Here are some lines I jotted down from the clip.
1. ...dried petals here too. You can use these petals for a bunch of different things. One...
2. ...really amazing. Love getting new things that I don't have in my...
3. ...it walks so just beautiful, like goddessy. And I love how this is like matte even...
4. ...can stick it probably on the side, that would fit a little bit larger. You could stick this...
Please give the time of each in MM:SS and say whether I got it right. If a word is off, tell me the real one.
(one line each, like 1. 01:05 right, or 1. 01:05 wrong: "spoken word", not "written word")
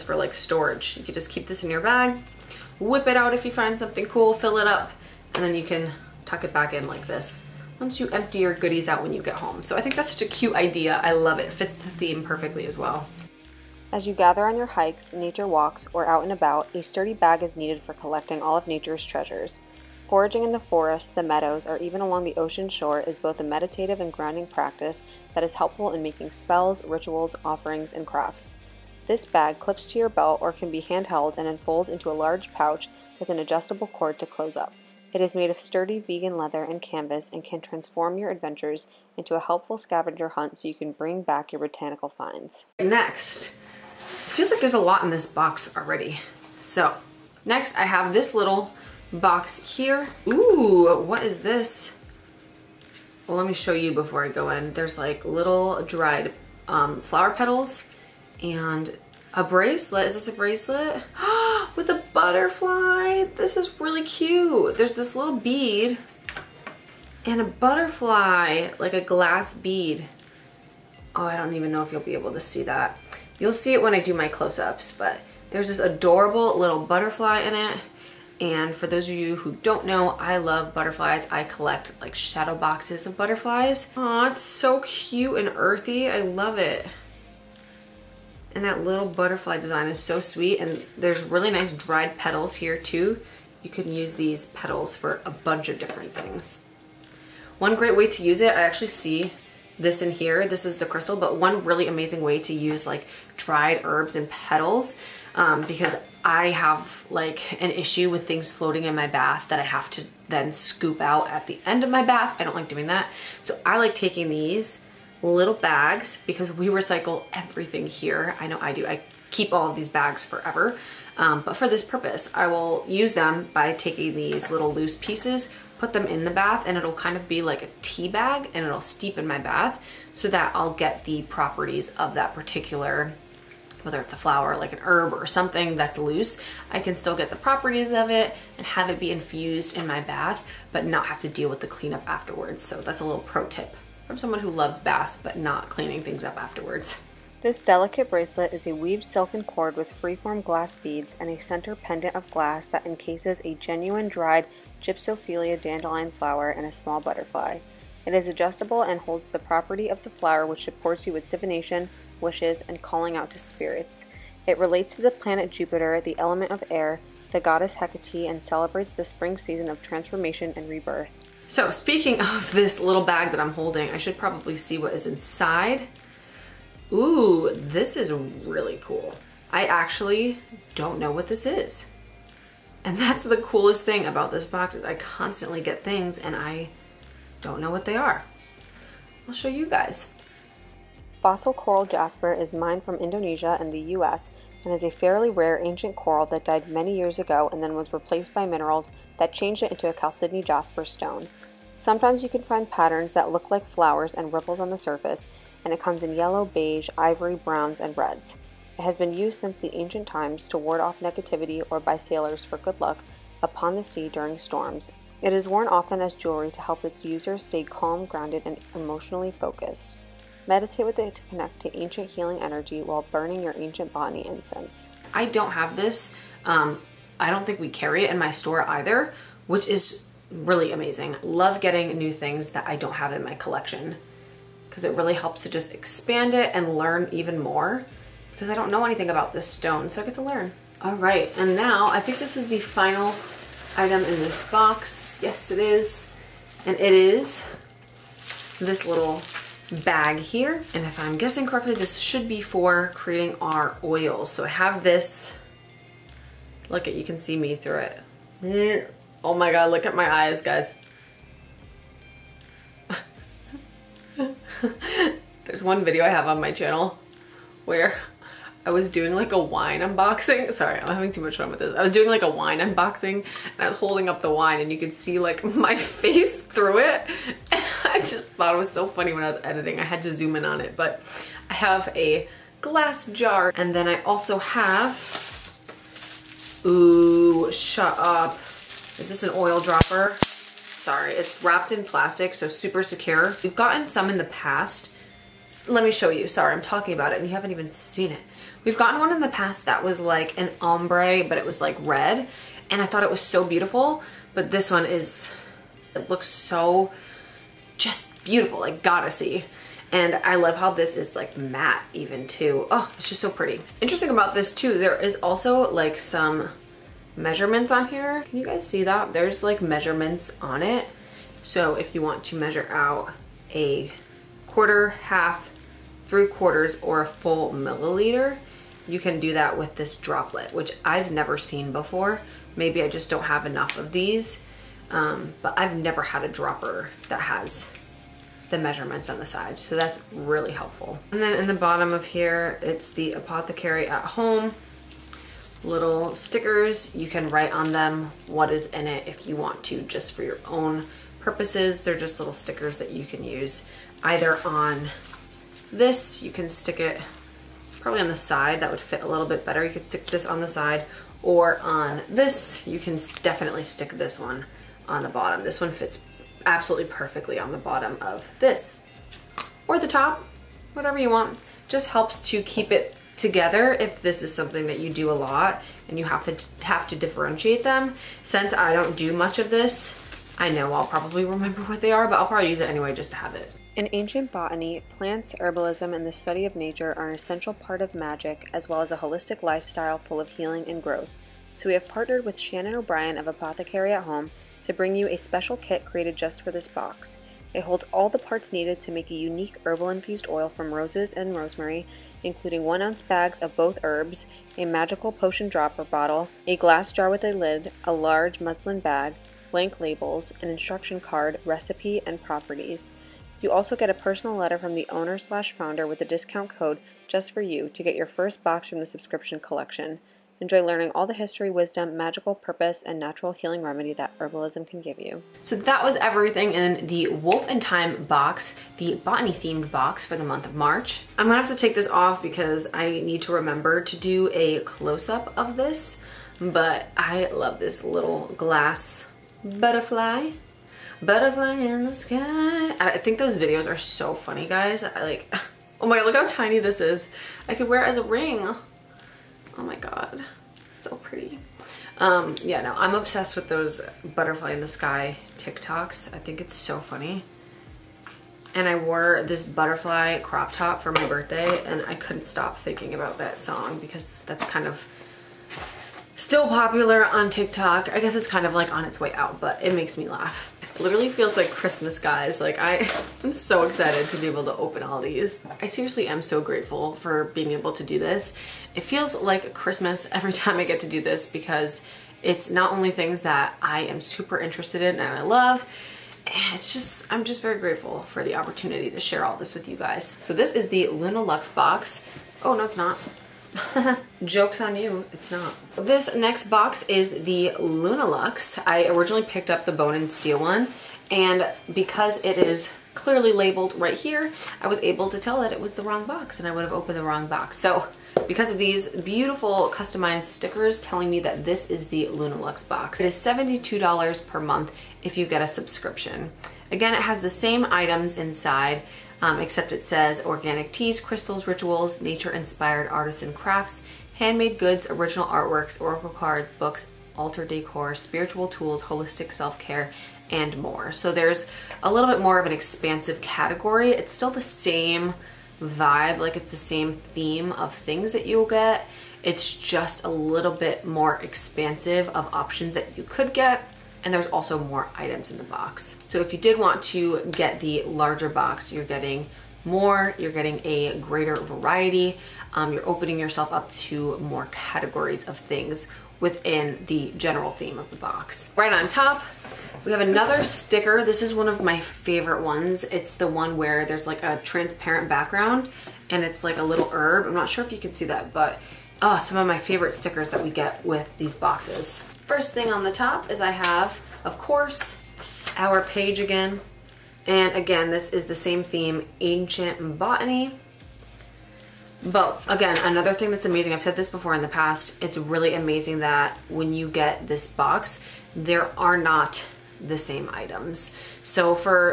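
1. 01:31 right
2. 03:50 right
3. 05:05 wrong: "looks", not "walks"
4. 05:56 wrong: "better", not "larger".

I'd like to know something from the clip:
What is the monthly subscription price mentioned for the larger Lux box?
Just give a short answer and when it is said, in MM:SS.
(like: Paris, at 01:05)
$72, at 08:33.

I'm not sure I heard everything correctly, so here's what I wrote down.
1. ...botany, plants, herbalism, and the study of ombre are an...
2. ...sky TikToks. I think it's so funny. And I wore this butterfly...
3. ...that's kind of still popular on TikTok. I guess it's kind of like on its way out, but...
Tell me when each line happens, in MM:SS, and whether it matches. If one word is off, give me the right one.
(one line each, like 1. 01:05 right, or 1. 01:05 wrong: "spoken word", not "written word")
1. 06:24 wrong: "nature", not "ombre"
2. 07:34 right
3. 07:44 right.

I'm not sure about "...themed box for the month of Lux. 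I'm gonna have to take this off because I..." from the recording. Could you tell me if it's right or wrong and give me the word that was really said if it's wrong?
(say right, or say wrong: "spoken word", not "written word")
wrong: "March", not "Lux".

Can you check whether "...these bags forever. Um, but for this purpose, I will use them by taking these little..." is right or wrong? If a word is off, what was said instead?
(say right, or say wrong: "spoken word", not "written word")
right.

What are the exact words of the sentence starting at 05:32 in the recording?
Maybe I just don't have enough of these, um, but I've never had a dropper that has the measurements on the side.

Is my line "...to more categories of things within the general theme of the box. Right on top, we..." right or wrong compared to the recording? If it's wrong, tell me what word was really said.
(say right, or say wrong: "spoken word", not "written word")
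right.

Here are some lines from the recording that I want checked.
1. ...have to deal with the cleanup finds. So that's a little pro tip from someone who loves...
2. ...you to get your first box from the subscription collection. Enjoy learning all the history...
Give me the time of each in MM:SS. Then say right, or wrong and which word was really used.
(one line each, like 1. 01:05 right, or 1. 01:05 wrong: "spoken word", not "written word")
1. 02:21 wrong: "afterwards", not "finds"
2. 06:57 right.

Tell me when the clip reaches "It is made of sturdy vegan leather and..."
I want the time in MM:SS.
00:35.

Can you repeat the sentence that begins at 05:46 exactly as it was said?
You can write on them what is in it if you want to, just for your own purposes.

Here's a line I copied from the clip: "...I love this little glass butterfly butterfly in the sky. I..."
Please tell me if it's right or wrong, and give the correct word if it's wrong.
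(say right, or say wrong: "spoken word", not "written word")
right.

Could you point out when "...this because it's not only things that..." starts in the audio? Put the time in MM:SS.
08:01.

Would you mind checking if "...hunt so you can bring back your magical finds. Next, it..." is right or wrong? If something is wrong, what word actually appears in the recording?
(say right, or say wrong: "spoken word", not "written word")
wrong: "botanical", not "magical".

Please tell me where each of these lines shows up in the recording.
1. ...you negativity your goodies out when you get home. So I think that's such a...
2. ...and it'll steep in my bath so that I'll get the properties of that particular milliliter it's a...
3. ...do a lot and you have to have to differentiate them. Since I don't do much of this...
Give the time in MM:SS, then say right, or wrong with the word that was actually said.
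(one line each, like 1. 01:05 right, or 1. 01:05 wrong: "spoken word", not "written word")
1. 00:07 wrong: "empty", not "negativity"
2. 02:08 wrong: "whether", not "milliliter"
3. 06:14 right.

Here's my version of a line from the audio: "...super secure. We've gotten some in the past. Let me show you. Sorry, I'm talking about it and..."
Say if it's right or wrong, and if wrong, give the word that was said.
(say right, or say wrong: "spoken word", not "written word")
right.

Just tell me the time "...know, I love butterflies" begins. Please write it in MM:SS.
01:19.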